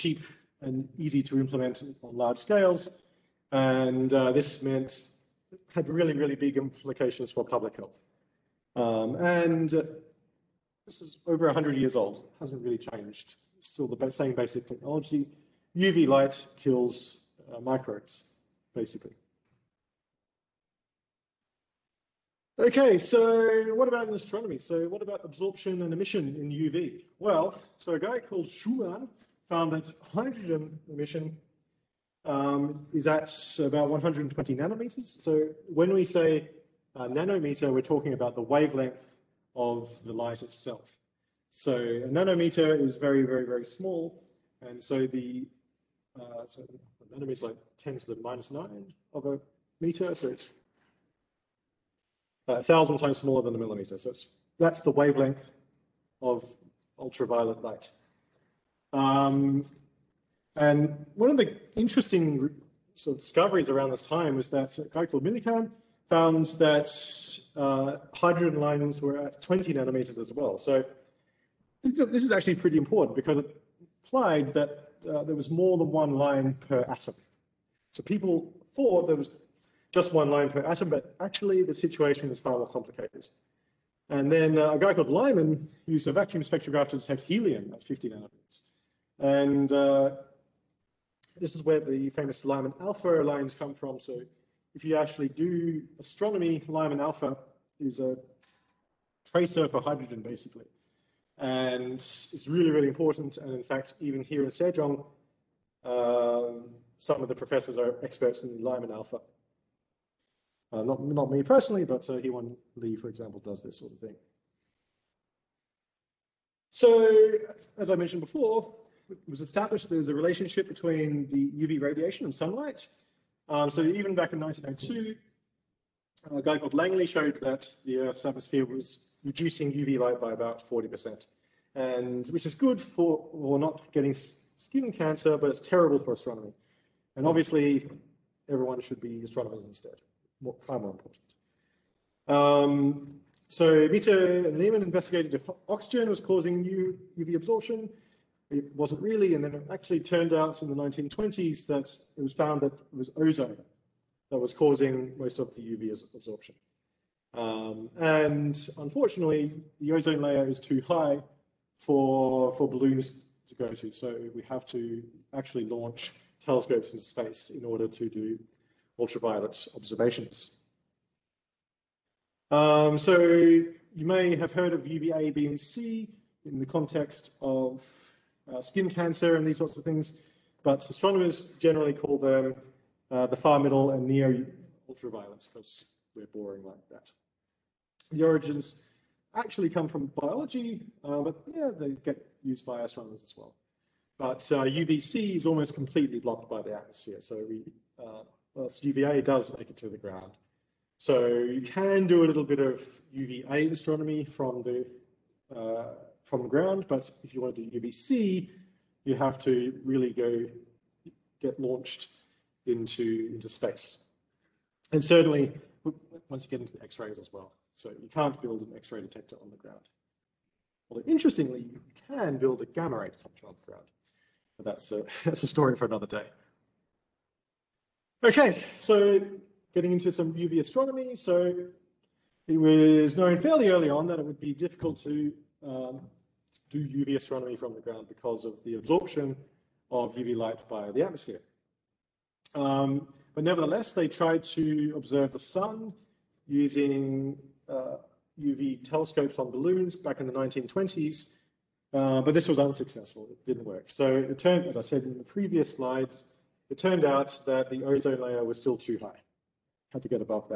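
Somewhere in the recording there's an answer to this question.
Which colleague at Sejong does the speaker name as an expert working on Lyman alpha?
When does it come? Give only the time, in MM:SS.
01:52.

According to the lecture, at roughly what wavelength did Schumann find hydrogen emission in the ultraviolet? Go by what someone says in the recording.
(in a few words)
120 nanometers.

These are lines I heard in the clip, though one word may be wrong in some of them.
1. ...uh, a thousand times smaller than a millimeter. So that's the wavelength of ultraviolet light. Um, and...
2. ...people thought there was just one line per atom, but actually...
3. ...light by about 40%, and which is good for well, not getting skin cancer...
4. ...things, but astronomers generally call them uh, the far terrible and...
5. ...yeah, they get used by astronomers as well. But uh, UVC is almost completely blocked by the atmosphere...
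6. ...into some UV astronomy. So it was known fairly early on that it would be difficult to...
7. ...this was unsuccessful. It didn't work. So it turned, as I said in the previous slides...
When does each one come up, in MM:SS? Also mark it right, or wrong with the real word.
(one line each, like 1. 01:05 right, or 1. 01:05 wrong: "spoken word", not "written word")
1. 00:52 right
2. 01:18 right
3. 02:09 right
4. 02:59 wrong: "middle", not "terrible"
5. 03:11 right
6. 03:49 right
7. 04:12 right.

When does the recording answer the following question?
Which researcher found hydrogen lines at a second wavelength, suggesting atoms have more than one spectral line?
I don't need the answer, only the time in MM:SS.
01:05.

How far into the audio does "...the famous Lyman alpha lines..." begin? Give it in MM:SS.
01:31.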